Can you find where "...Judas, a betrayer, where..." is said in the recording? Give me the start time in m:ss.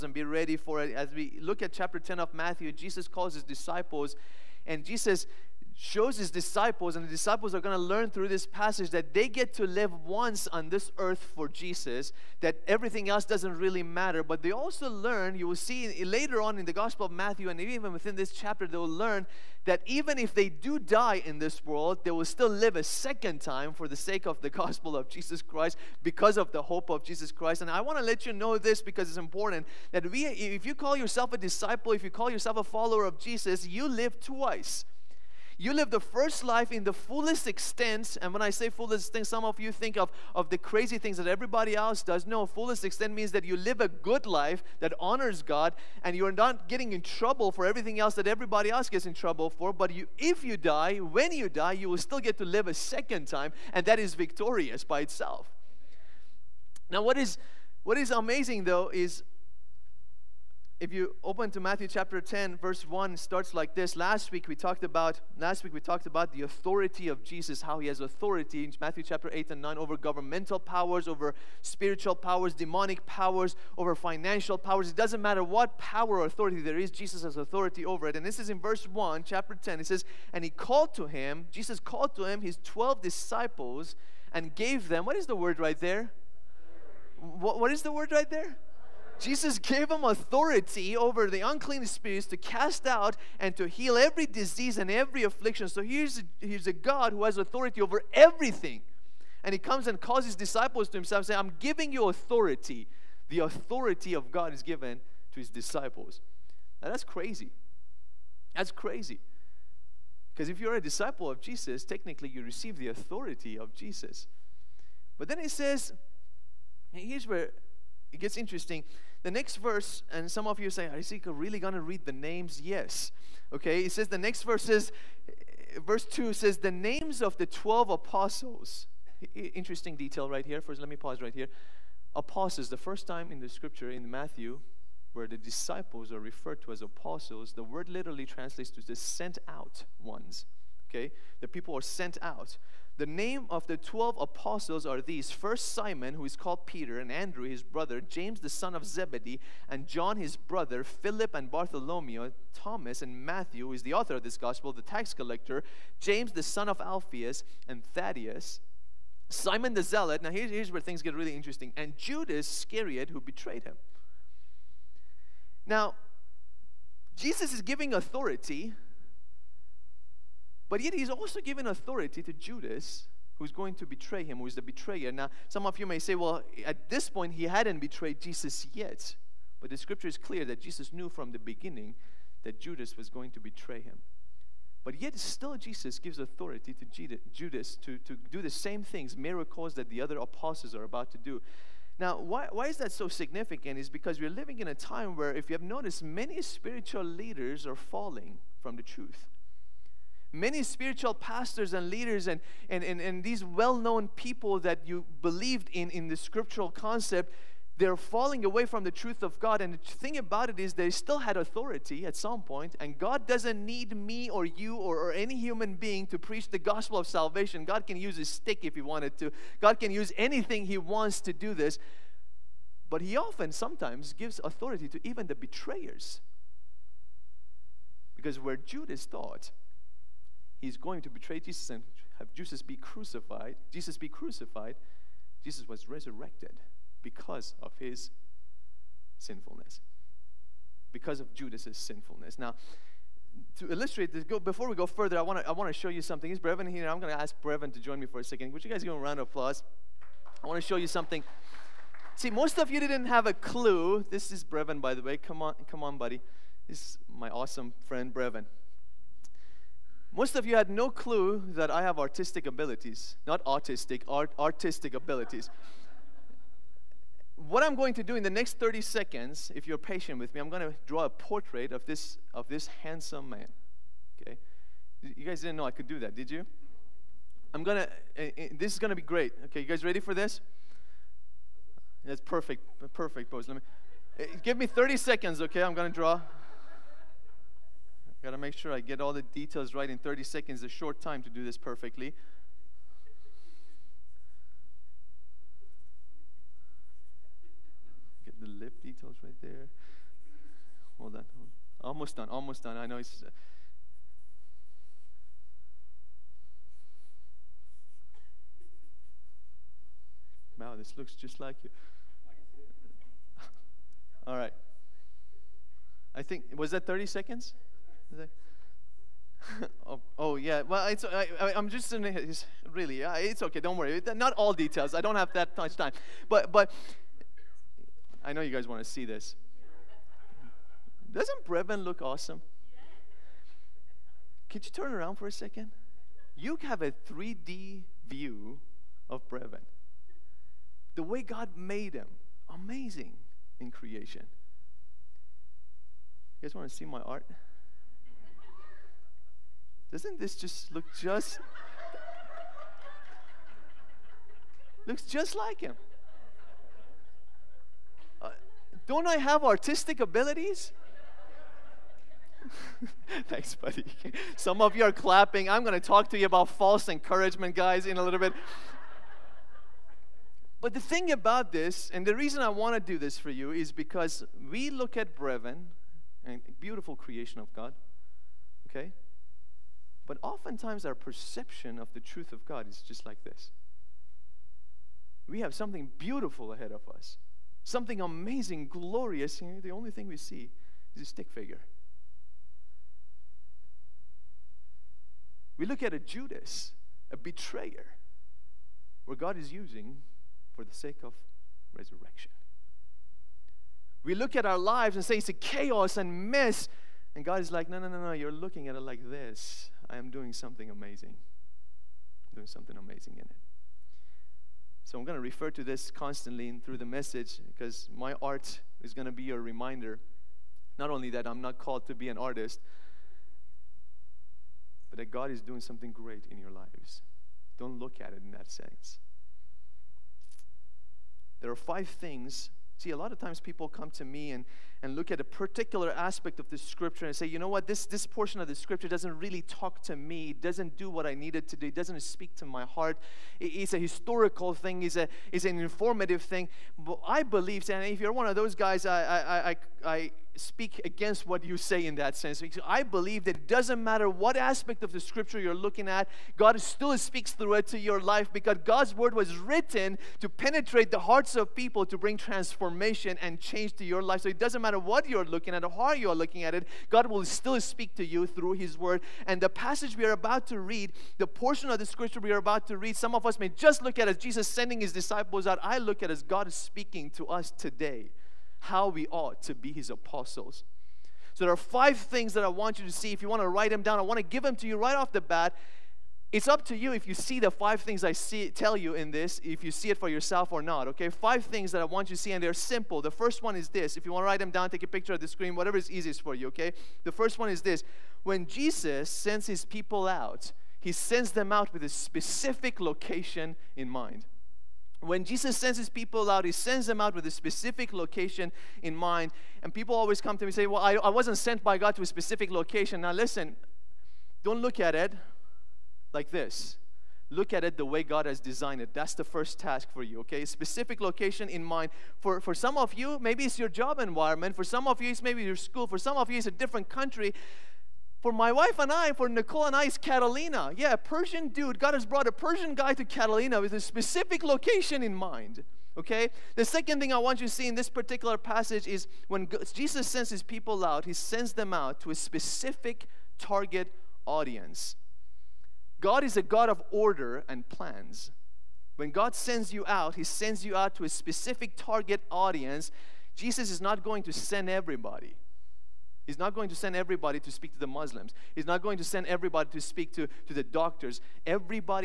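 6:35.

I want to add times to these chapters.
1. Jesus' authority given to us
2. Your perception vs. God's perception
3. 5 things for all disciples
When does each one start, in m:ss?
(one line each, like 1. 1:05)
1. 0:50
2. 4:02
3. 7:40.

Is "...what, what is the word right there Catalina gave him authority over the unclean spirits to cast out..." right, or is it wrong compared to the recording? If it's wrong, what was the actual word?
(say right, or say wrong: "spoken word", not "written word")
wrong: "Jesus", not "Catalina".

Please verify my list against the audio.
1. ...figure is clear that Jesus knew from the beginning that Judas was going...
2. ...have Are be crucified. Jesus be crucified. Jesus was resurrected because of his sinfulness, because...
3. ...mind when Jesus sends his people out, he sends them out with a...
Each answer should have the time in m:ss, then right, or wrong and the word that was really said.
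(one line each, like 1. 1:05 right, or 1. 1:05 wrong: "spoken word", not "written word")
1. 2:59 wrong: "scripture", not "figure"
2. 3:52 wrong: "Jesus", not "Are"
3. 8:23 right.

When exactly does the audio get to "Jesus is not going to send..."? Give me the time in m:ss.
9:13.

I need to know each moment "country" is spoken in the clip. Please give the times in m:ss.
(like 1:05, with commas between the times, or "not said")
8:46.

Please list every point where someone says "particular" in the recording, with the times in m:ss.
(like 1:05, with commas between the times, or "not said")
7:15, 8:57.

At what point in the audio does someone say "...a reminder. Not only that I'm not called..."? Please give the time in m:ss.
6:59.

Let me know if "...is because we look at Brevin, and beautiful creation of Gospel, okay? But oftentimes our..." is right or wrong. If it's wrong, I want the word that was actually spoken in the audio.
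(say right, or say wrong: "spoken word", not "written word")
wrong: "God", not "Gospel".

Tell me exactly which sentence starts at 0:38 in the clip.
And when I say fullest extent, some of you think of, of the crazy things that everybody else does.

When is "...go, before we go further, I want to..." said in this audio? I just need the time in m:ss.
4:04.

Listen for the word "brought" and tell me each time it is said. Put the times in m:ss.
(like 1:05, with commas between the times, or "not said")
8:52.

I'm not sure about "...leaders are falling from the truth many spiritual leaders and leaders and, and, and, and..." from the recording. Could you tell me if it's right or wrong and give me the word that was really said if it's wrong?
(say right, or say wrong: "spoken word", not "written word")
wrong: "pastors", not "leaders".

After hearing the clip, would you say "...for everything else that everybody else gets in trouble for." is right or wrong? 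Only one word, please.
right.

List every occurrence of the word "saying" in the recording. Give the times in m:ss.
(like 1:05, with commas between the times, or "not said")
1:41.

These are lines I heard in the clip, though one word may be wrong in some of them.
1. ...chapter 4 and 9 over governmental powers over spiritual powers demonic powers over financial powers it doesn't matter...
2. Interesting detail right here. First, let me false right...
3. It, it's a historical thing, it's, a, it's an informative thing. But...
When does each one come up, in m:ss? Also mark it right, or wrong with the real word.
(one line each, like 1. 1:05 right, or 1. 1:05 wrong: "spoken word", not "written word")
1. 1:09 wrong: "8", not "4"
2. 2:09 wrong: "pause", not "false"
3. 7:23 right.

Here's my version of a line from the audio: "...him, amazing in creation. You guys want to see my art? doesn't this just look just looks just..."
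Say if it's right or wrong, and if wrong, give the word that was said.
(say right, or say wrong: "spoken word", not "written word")
right.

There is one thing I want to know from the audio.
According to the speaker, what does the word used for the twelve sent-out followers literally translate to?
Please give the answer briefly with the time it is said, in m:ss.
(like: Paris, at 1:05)
the sent out ones, at 2:18.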